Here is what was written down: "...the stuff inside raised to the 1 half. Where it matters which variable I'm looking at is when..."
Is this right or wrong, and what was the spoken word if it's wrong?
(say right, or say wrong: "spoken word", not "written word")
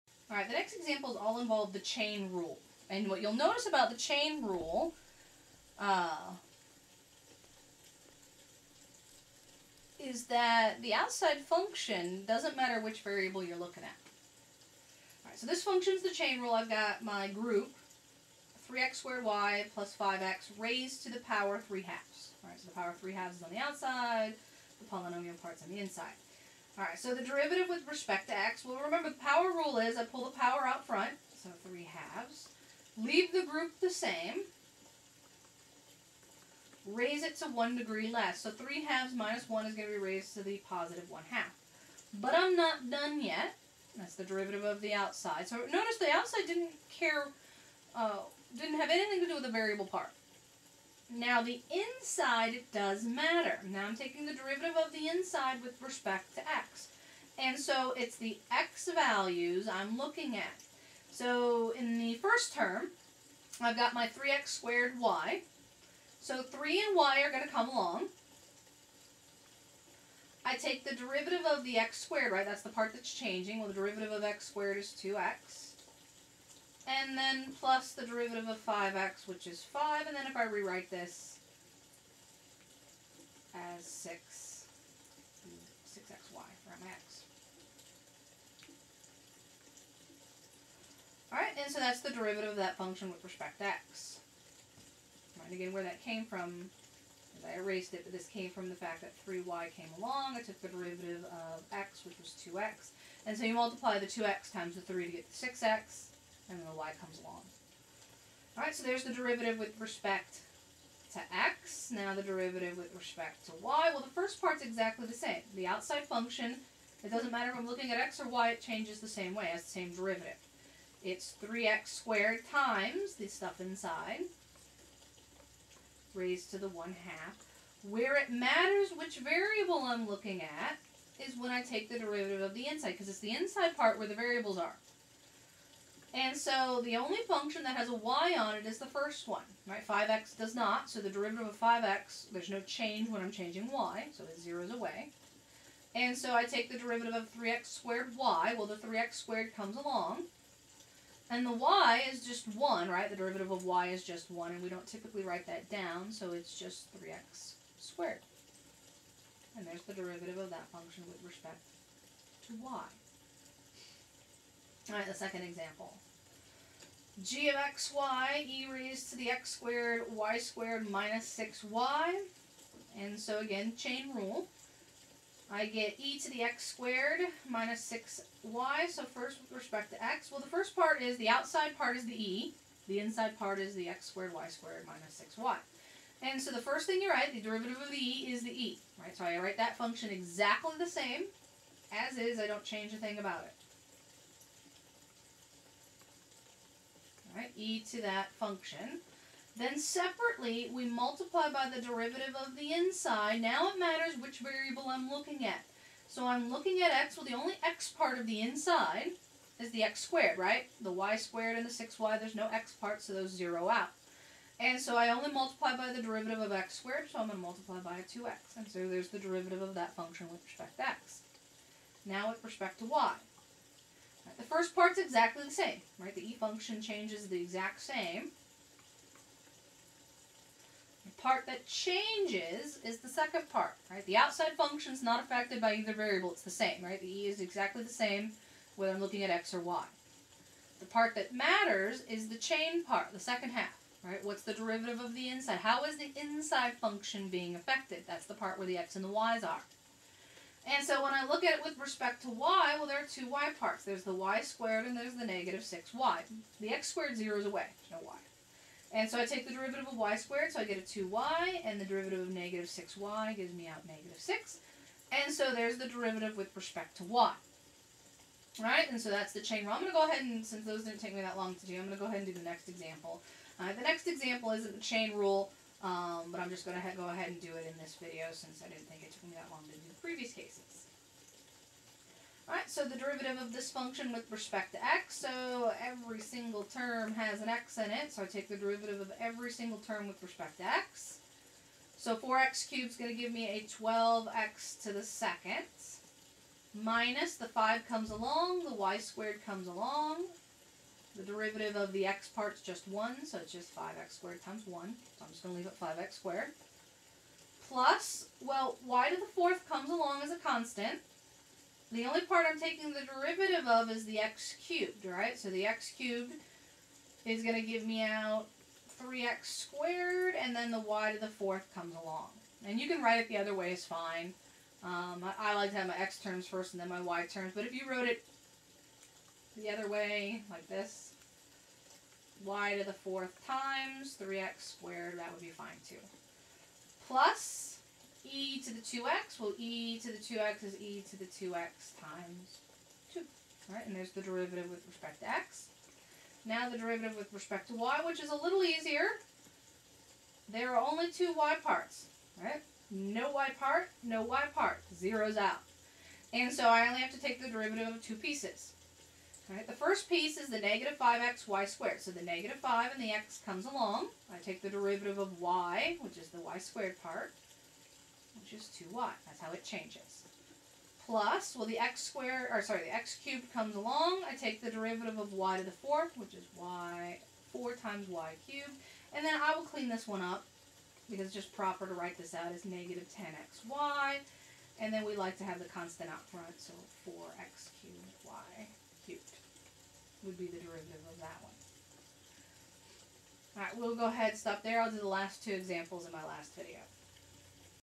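right.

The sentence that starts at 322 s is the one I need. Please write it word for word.
And you can write it the other way is fine.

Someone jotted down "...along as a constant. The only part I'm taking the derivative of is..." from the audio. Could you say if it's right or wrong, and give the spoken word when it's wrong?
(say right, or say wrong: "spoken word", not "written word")
right.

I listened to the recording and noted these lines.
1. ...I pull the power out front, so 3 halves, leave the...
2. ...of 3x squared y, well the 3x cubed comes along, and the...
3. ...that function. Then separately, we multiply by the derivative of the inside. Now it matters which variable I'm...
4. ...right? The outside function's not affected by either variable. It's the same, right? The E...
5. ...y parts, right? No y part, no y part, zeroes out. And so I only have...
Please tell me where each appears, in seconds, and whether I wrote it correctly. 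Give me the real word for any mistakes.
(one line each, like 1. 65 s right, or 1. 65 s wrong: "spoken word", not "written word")
1. 29 s right
2. 147 s wrong: "squared", not "cubed"
3. 198 s right
4. 233 s right
5. 351 s right.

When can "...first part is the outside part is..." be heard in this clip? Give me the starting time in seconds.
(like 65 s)
180 s.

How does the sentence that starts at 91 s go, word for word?
Alright, and so that's the derivative of that function with respect to x.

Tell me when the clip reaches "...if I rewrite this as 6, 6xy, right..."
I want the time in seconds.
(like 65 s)
80 s.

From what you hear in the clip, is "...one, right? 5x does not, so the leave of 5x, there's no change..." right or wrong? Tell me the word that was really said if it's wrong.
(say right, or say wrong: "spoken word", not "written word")
wrong: "derivative", not "leave".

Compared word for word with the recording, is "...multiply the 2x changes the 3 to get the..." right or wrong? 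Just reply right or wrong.
wrong.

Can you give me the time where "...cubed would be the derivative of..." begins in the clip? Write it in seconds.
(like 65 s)
389 s.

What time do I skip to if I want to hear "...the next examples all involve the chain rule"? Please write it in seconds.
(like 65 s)
0 s.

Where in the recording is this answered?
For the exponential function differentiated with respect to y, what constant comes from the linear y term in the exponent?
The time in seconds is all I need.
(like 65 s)
263 s.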